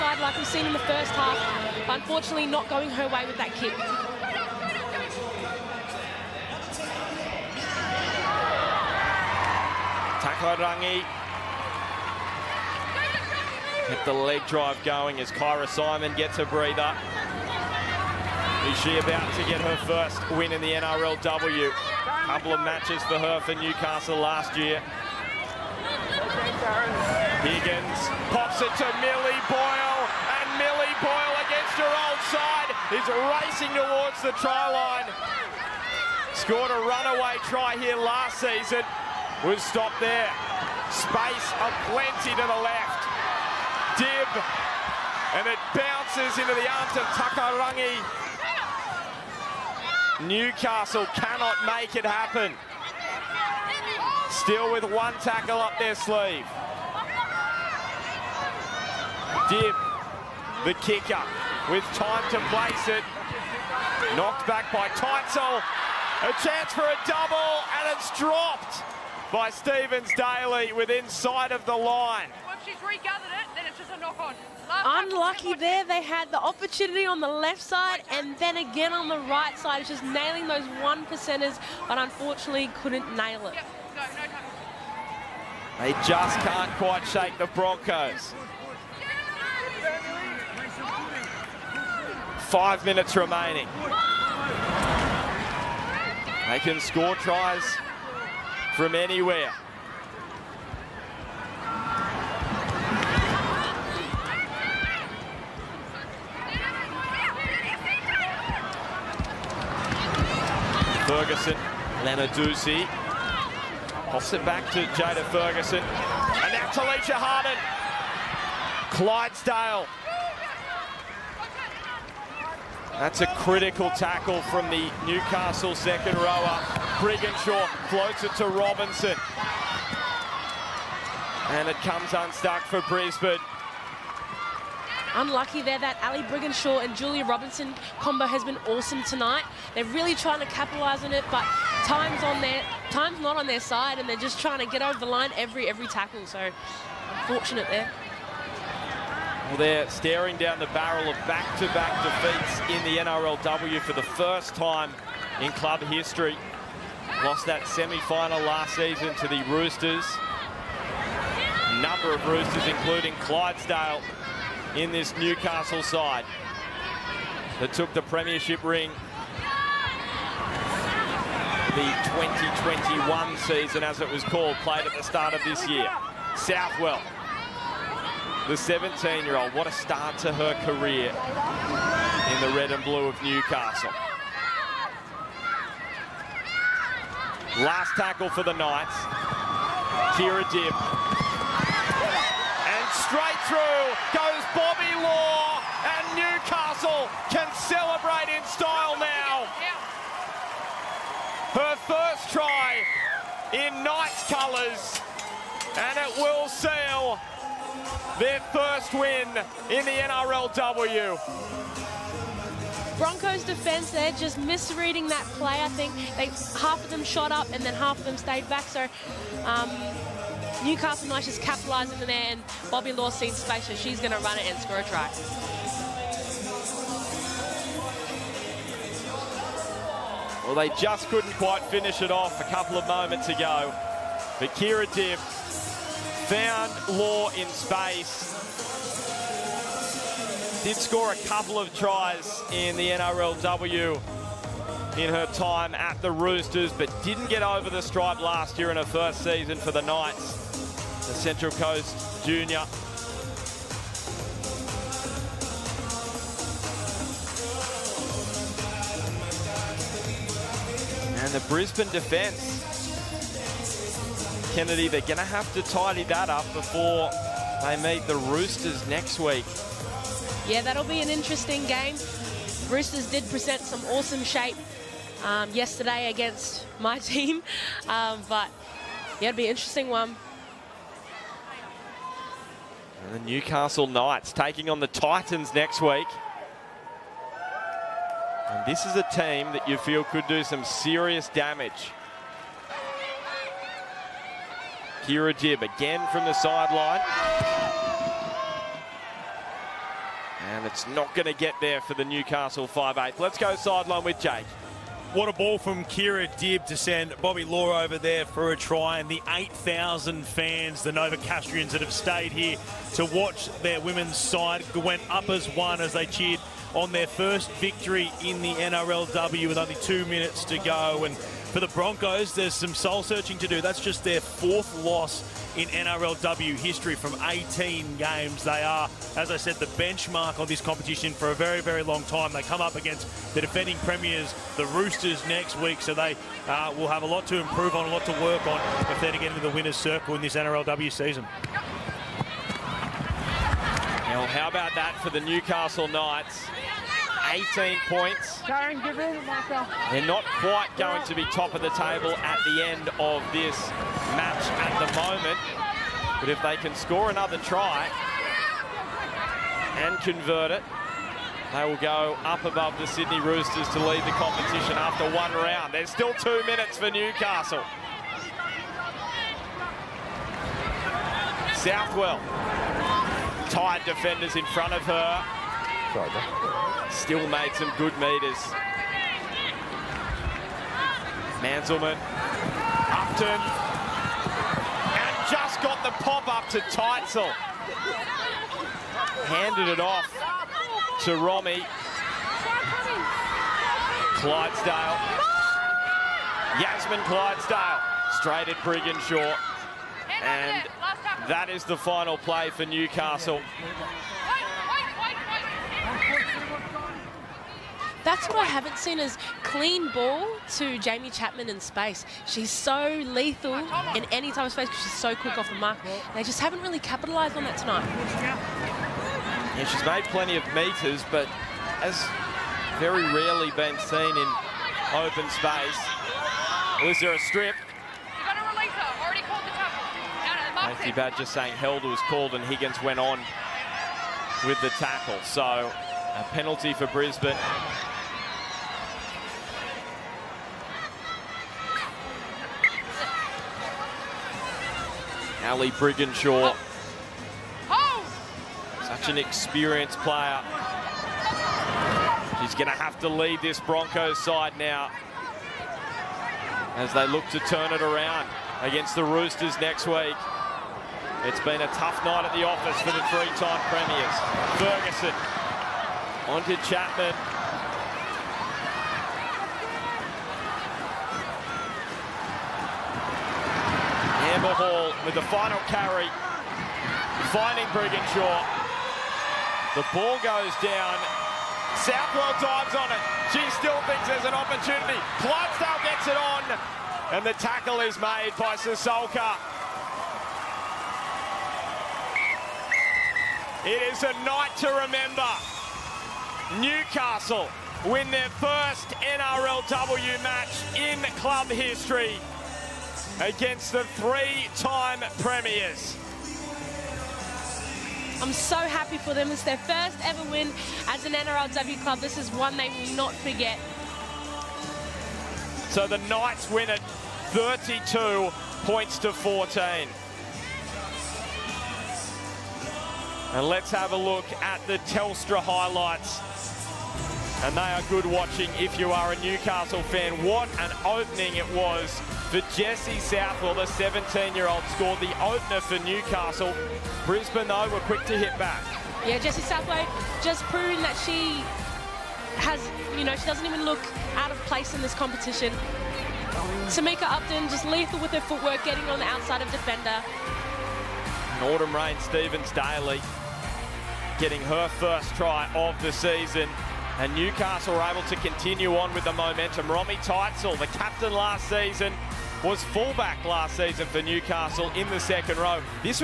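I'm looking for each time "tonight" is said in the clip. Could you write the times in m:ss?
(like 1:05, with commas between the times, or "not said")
2:19, 6:57.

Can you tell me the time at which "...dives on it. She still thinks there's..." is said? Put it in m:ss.
8:02.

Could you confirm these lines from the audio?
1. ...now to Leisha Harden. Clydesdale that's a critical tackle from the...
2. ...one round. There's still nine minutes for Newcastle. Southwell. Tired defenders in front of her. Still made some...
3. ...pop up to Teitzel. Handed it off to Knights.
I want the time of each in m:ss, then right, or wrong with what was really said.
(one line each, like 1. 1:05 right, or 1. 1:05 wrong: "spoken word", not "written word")
1. 1:56 right
2. 6:05 wrong: "two", not "nine"
3. 6:26 wrong: "Romy", not "Knights".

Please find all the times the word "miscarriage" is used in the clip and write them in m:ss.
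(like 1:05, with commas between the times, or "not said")
not said.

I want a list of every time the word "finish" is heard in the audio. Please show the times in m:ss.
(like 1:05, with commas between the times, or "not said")
3:51.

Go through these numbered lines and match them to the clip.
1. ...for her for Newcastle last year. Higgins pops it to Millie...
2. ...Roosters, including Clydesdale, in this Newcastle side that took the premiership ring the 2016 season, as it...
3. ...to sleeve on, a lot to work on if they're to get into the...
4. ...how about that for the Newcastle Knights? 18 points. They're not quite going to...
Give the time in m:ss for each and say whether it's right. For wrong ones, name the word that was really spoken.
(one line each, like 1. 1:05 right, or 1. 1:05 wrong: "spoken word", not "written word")
1. 0:23 right
2. 2:42 wrong: "2021", not "2016"
3. 5:37 wrong: "improve", not "sleeve"
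4. 5:44 right.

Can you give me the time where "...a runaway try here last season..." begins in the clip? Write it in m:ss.
0:36.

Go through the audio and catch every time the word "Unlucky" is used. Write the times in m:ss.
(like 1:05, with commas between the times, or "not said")
1:15, 2:15.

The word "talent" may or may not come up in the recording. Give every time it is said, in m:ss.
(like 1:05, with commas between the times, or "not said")
not said.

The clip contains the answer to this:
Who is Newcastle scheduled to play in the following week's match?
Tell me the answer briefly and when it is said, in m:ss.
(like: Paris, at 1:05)
Titans, at 4:44.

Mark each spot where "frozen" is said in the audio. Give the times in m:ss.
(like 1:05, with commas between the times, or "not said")
not said.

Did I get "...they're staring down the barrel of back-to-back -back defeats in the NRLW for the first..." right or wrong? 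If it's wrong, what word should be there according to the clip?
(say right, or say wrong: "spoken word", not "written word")
right.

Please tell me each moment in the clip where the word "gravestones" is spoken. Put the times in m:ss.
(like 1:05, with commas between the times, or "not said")
not said.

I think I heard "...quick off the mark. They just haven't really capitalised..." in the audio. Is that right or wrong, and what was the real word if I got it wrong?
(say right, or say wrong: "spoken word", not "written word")
right.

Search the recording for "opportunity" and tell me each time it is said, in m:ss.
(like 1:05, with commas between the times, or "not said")
1:16, 8:04.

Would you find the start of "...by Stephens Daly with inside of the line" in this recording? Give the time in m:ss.
1:09.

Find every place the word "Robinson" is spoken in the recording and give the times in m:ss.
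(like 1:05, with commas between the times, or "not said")
2:08, 2:17.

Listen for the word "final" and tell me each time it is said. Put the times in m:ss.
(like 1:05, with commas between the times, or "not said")
2:37, 6:41, 7:55.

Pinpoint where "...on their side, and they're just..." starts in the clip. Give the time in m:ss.
2:23.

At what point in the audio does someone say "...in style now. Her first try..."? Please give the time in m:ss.
3:18.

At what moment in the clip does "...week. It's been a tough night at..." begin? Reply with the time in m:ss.
7:39.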